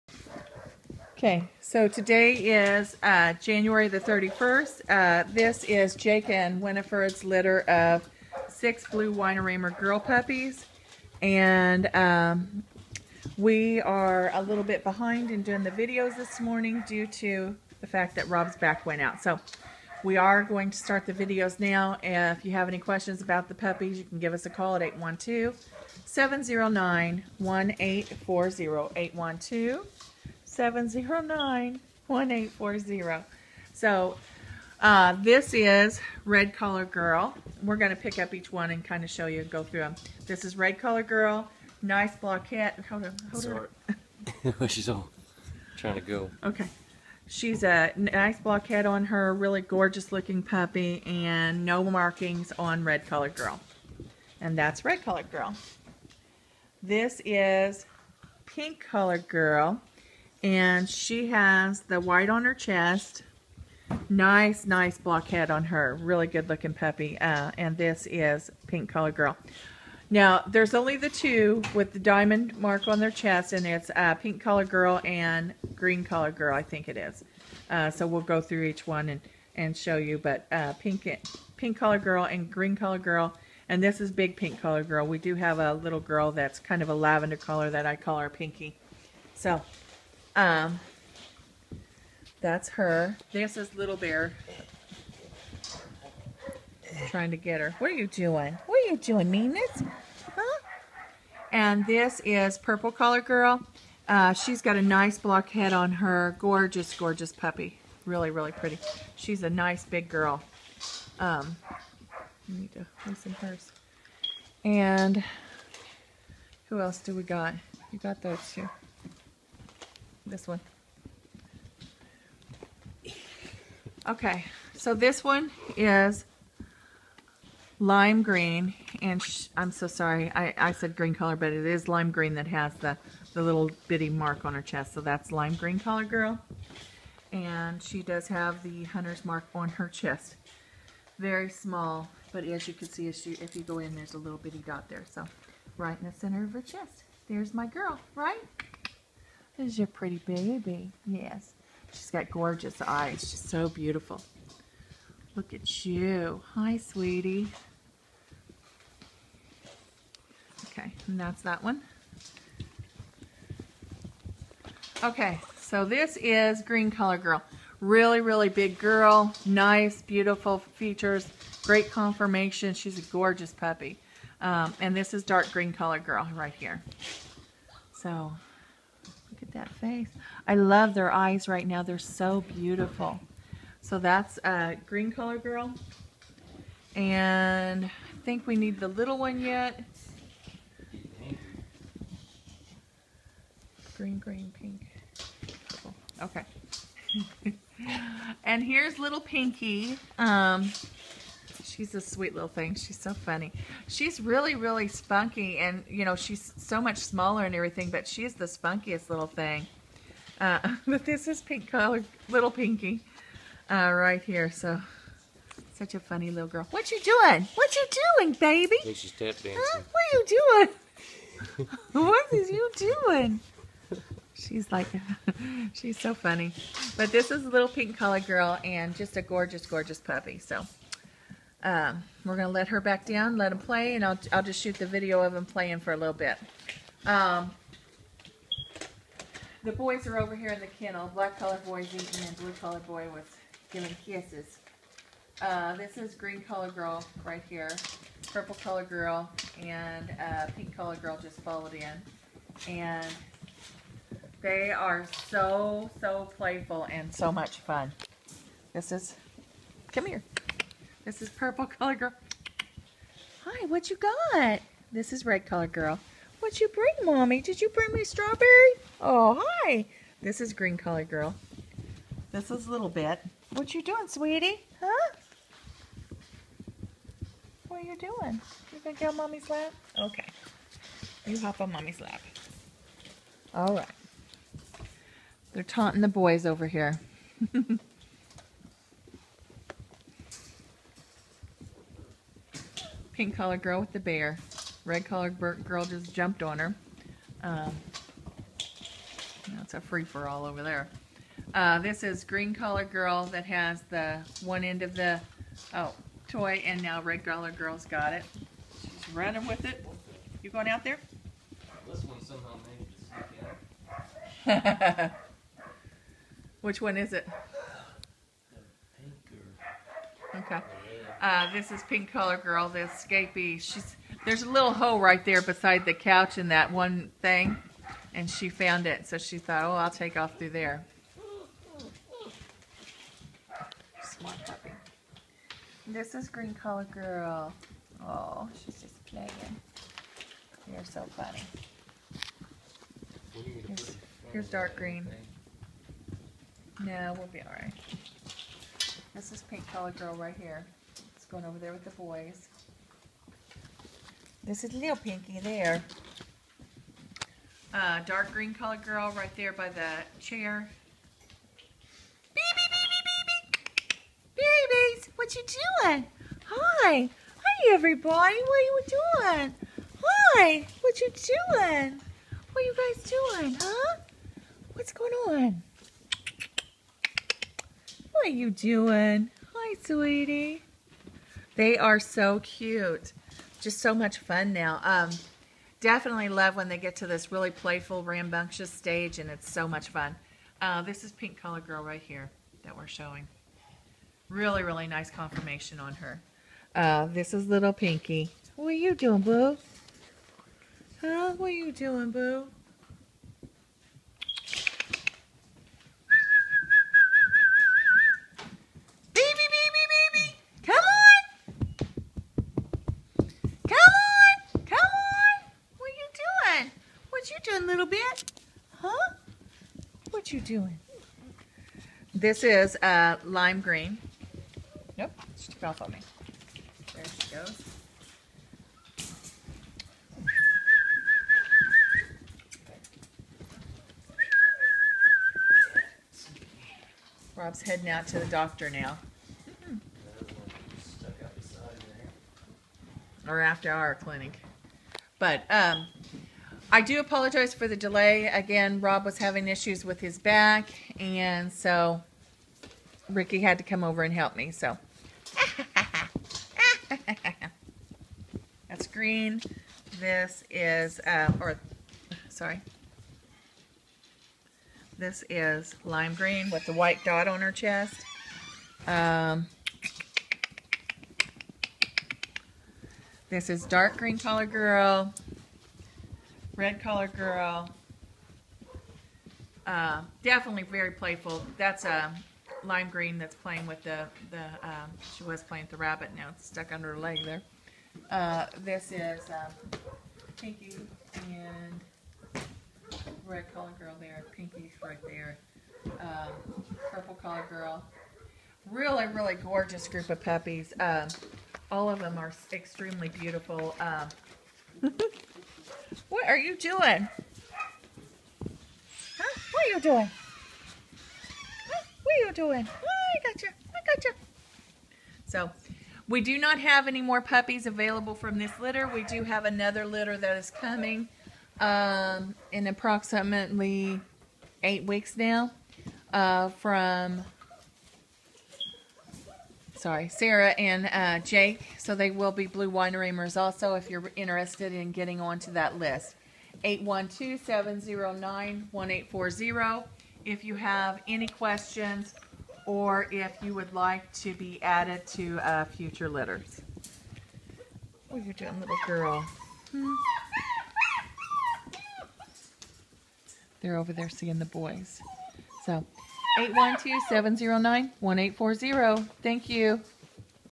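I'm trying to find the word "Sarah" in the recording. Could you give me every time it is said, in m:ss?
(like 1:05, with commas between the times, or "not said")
8:50.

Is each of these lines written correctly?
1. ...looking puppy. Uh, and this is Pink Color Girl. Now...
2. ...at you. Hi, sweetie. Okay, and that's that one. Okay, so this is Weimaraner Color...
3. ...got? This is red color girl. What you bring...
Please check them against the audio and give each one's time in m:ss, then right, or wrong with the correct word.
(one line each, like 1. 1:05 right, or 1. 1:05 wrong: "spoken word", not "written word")
1. 1:06 right
2. 2:35 wrong: "Green", not "Weimaraner"
3. 4:24 right.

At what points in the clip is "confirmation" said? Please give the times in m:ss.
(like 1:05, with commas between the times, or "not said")
2:51, 6:35.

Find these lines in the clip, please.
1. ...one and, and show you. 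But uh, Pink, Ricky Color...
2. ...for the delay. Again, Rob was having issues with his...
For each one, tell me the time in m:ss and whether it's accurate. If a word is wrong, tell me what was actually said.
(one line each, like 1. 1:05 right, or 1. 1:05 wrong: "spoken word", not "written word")
1. 1:18 wrong: "Pink", not "Ricky"
2. 7:27 right.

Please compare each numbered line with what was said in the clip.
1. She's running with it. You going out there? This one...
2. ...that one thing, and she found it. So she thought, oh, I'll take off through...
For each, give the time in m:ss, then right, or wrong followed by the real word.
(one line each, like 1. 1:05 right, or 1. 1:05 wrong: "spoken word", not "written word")
1. 5:08 right
2. 5:26 right.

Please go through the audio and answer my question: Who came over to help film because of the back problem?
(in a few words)
Ricky.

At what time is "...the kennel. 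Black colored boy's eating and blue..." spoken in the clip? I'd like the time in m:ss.
4:00.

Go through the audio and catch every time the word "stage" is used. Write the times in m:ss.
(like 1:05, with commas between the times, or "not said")
6:28.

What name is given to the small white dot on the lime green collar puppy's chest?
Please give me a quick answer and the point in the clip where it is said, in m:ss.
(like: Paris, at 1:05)
hunter's mark, at 2:18.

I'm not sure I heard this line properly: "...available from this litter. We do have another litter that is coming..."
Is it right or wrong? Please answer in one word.
right.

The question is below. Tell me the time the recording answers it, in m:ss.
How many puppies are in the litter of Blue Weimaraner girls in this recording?
0:08.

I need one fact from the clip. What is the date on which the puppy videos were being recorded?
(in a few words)
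January 31st.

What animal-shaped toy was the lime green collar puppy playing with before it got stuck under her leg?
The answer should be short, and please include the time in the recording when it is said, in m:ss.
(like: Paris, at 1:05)
rabbit, at 8:05.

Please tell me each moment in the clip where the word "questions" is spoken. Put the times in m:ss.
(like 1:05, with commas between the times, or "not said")
0:22, 9:01.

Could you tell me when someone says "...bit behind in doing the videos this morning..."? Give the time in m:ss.
0:14.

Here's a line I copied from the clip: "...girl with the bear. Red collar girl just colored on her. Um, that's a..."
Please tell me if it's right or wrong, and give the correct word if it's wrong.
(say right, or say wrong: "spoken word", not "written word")
wrong: "jumped", not "colored".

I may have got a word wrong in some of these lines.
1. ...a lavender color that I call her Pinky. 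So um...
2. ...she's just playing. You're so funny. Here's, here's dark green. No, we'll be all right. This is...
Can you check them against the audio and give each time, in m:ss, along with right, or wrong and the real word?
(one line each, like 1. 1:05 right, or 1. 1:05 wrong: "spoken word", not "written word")
1. 1:26 right
2. 5:38 right.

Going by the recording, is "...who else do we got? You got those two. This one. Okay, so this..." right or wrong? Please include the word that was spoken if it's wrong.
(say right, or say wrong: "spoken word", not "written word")
right.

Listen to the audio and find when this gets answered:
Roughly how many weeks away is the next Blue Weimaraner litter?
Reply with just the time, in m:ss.
8:44.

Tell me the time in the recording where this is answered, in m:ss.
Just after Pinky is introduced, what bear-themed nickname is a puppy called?
1:33.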